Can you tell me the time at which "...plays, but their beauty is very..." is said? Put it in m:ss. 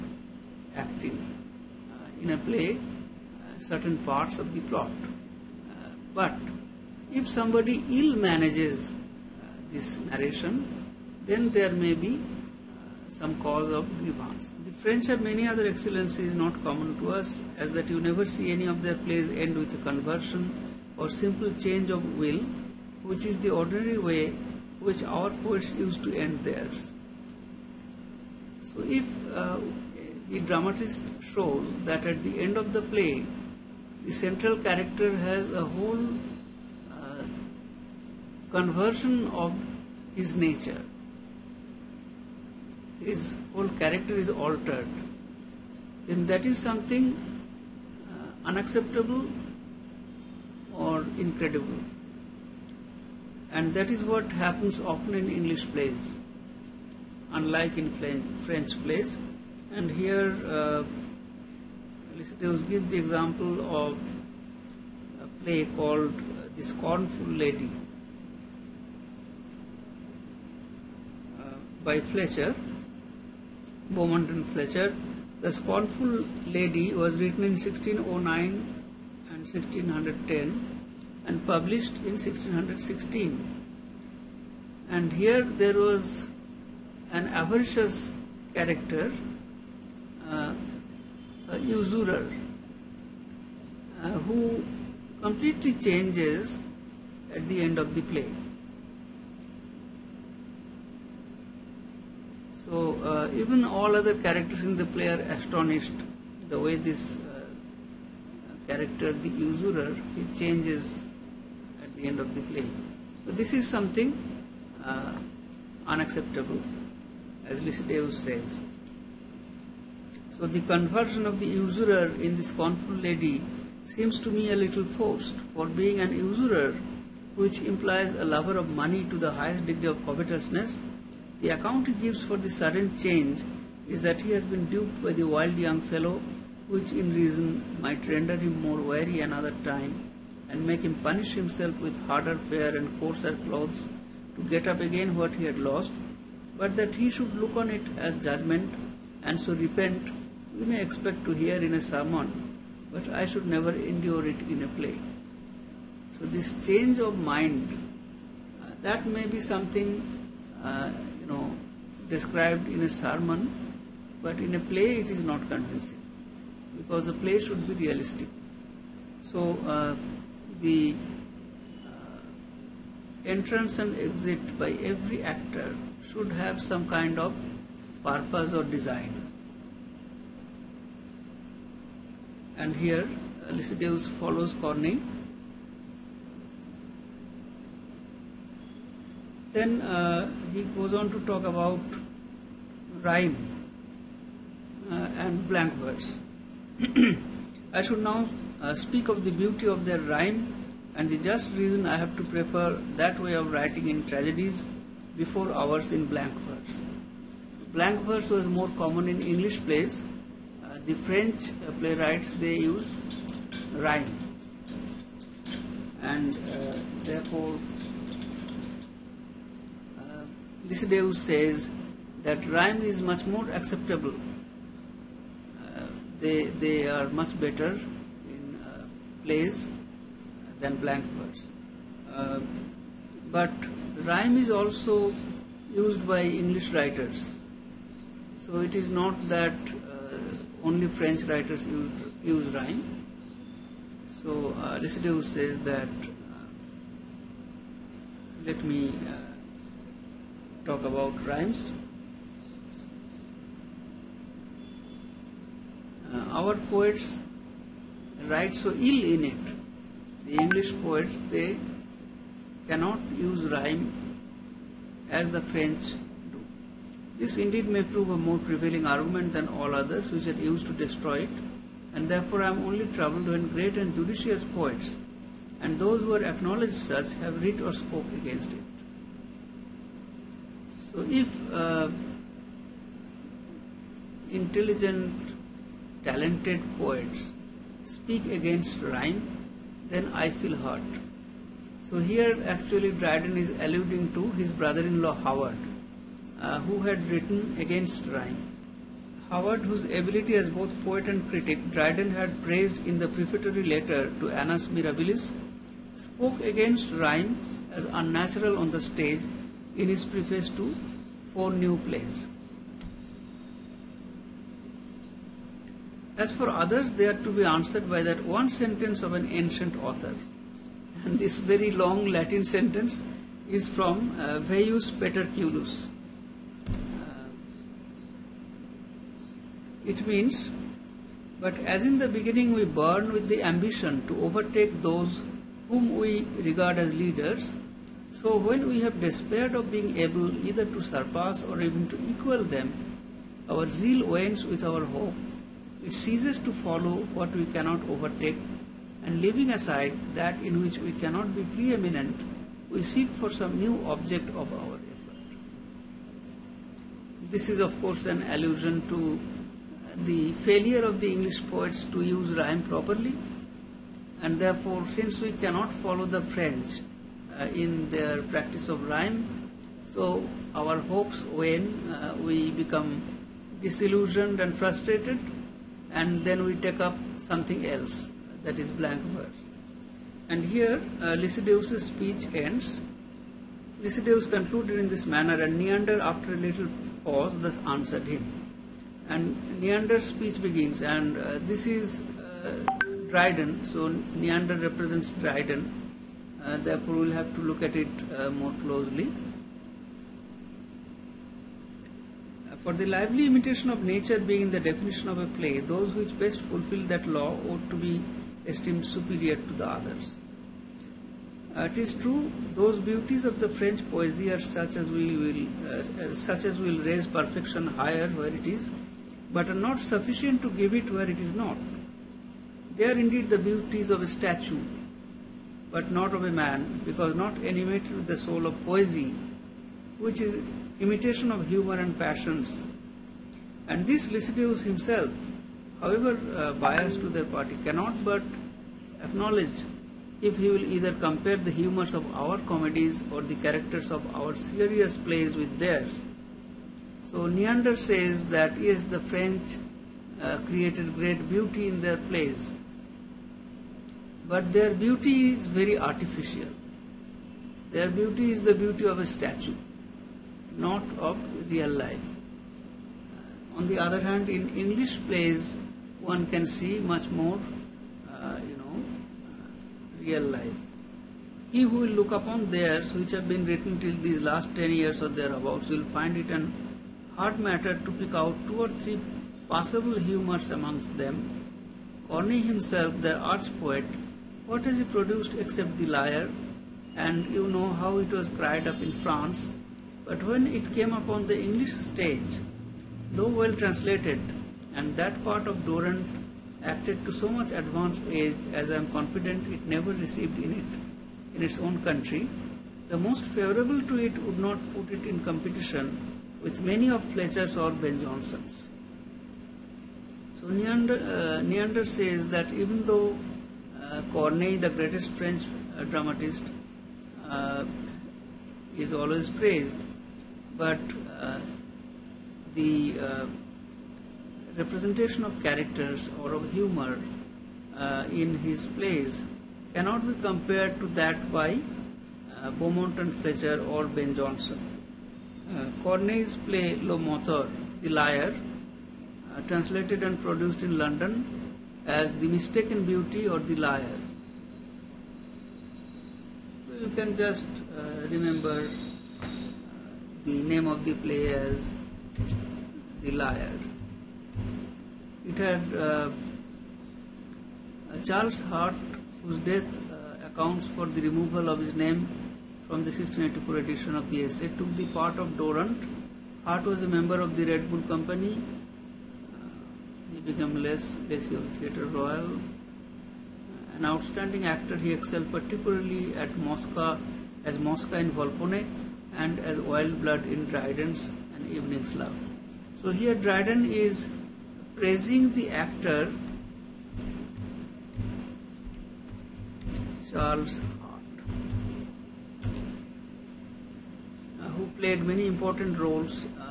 7:31.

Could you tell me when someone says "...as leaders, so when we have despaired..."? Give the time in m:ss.
5:36.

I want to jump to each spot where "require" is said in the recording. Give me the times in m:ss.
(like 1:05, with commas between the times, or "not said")
not said.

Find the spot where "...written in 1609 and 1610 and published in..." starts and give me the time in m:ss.
1:17.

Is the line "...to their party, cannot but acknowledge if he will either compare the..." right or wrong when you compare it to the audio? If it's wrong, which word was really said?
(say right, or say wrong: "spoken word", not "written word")
right.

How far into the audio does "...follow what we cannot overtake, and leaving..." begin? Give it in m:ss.
5:46.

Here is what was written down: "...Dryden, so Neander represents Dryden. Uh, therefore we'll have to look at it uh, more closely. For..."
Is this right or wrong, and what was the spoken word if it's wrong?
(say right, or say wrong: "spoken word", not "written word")
right.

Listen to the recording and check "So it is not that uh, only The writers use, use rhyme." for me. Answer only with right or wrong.
wrong.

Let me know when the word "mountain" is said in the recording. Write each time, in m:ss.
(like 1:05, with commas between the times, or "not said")
not said.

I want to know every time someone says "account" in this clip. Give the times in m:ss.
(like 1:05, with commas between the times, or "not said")
2:11, 9:20.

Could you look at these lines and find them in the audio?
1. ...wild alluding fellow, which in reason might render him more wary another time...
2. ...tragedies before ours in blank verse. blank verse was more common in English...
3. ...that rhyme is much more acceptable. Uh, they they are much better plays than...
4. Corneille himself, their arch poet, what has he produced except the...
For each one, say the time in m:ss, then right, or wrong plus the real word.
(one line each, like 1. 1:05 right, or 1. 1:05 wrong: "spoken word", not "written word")
1. 2:15 wrong: "young", not "alluding"
2. 3:24 right
3. 3:42 right
4. 8:02 right.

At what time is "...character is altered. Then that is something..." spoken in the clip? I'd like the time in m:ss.
0:43.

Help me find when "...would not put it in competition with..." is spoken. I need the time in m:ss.
8:24.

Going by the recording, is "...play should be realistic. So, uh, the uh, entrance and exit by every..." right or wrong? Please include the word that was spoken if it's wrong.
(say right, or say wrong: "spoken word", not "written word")
right.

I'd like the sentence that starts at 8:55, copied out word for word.
Corneille's play Le Menteur, The Liar, translated and produced in London as The Mistaken Beauty or The Liar.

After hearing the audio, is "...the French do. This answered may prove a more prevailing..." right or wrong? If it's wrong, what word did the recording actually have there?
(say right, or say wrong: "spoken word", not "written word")
wrong: "indeed", not "answered".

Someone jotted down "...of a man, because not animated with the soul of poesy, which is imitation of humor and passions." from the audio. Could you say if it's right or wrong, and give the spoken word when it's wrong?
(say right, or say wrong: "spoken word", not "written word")
right.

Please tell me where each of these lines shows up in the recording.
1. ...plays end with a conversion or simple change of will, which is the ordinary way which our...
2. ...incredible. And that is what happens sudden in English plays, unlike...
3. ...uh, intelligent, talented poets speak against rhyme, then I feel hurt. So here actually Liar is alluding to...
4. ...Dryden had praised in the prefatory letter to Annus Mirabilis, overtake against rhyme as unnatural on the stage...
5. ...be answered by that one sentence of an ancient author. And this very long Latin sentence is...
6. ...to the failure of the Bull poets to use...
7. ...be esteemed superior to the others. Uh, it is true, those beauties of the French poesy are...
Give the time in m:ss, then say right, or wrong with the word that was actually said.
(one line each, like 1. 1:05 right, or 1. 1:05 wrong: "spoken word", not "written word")
1. 0:19 right
2. 0:51 wrong: "often", not "sudden"
3. 4:41 wrong: "Dryden", not "Liar"
4. 5:01 wrong: "spoke", not "overtake"
5. 5:17 right
6. 5:58 wrong: "English", not "Bull"
7. 6:47 right.